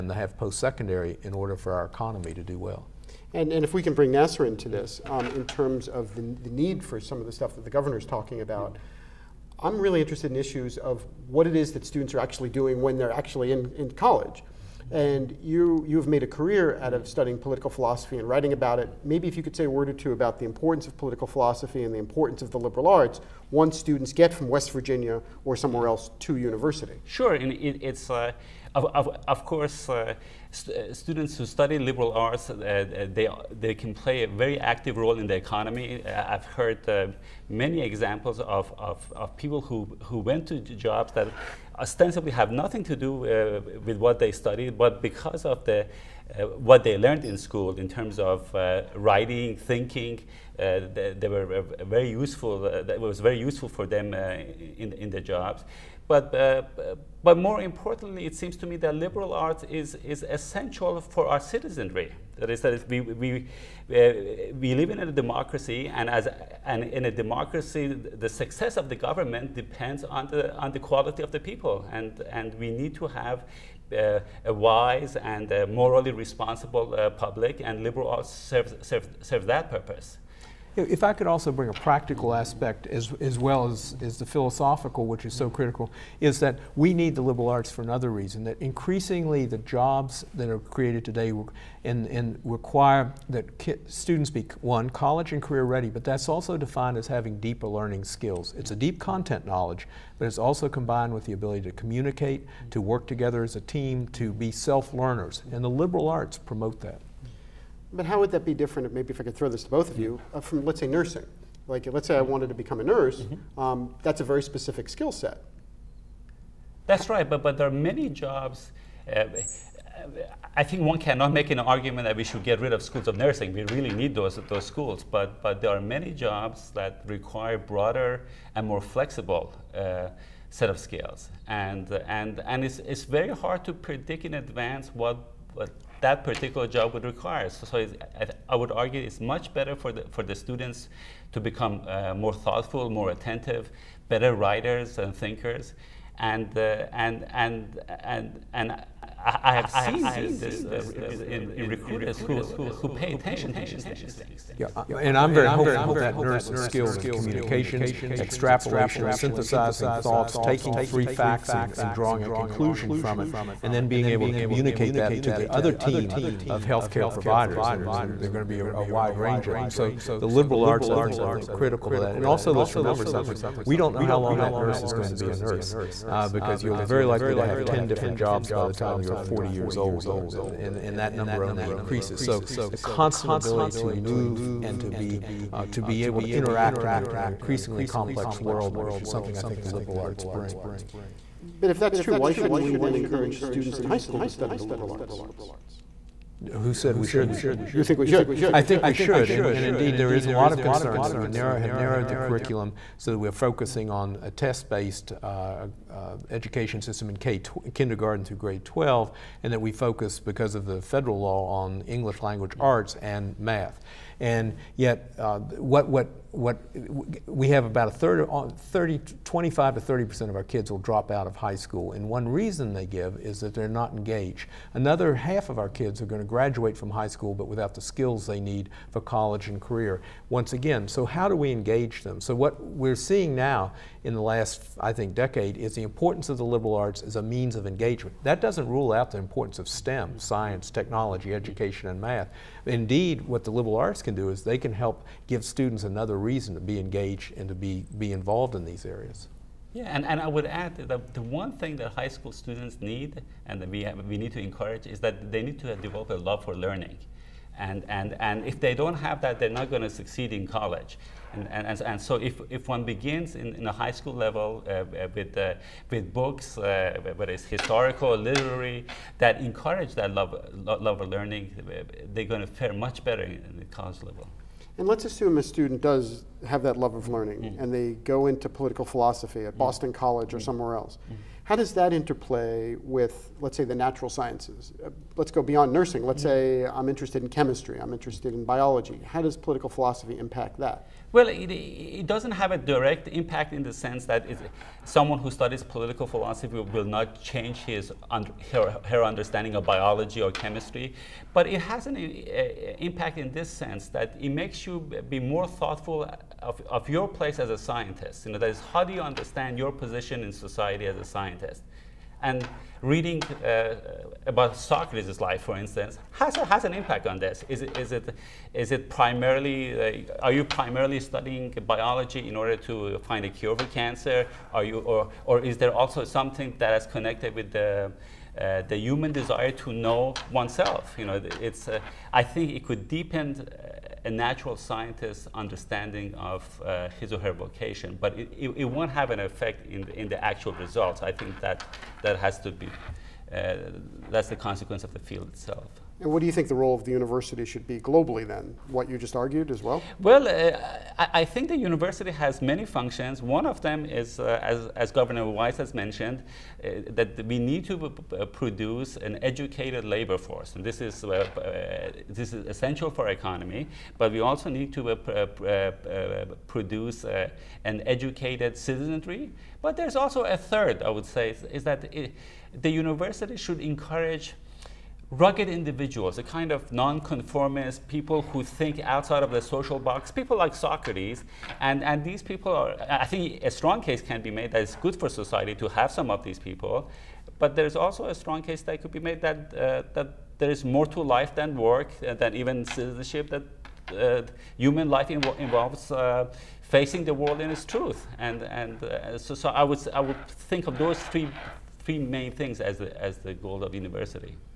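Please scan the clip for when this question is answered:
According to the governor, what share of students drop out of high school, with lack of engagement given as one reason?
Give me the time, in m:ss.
3:39.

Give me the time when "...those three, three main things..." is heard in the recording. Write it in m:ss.
6:40.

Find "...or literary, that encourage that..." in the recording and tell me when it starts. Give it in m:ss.
4:28.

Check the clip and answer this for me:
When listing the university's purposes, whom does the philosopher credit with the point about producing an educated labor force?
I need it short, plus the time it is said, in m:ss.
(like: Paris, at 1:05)
Governor Wise, at 5:54.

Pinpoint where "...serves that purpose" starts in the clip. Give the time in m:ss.
1:19.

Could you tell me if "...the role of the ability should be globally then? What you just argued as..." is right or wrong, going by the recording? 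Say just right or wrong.
wrong.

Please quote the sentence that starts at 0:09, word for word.
I'm really interested in issues of what it is that students are actually doing when they're actually in, in college.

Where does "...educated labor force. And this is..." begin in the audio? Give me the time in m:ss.
5:59.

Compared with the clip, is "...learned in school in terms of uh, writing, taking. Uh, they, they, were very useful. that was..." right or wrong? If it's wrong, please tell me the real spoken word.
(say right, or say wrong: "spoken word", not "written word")
wrong: "thinking", not "taking".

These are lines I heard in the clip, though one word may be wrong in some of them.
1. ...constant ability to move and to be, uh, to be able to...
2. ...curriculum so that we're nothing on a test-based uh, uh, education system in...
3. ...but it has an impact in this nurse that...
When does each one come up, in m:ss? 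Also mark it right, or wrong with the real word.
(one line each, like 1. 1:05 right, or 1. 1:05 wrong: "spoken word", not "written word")
1. 3:02 right
2. 3:22 wrong: "focusing", not "nothing"
3. 5:01 wrong: "sense", not "nurse".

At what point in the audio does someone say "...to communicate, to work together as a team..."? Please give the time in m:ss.
1:41.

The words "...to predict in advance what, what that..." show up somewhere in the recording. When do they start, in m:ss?
2:13.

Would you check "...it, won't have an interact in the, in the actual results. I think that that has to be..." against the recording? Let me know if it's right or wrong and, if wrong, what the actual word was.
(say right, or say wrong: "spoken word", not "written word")
wrong: "effect", not "interact".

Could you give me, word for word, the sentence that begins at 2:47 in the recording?
And there, are going to be a, a, wide range of them.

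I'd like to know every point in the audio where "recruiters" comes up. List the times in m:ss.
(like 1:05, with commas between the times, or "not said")
2:31.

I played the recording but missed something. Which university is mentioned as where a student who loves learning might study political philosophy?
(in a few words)
Boston College.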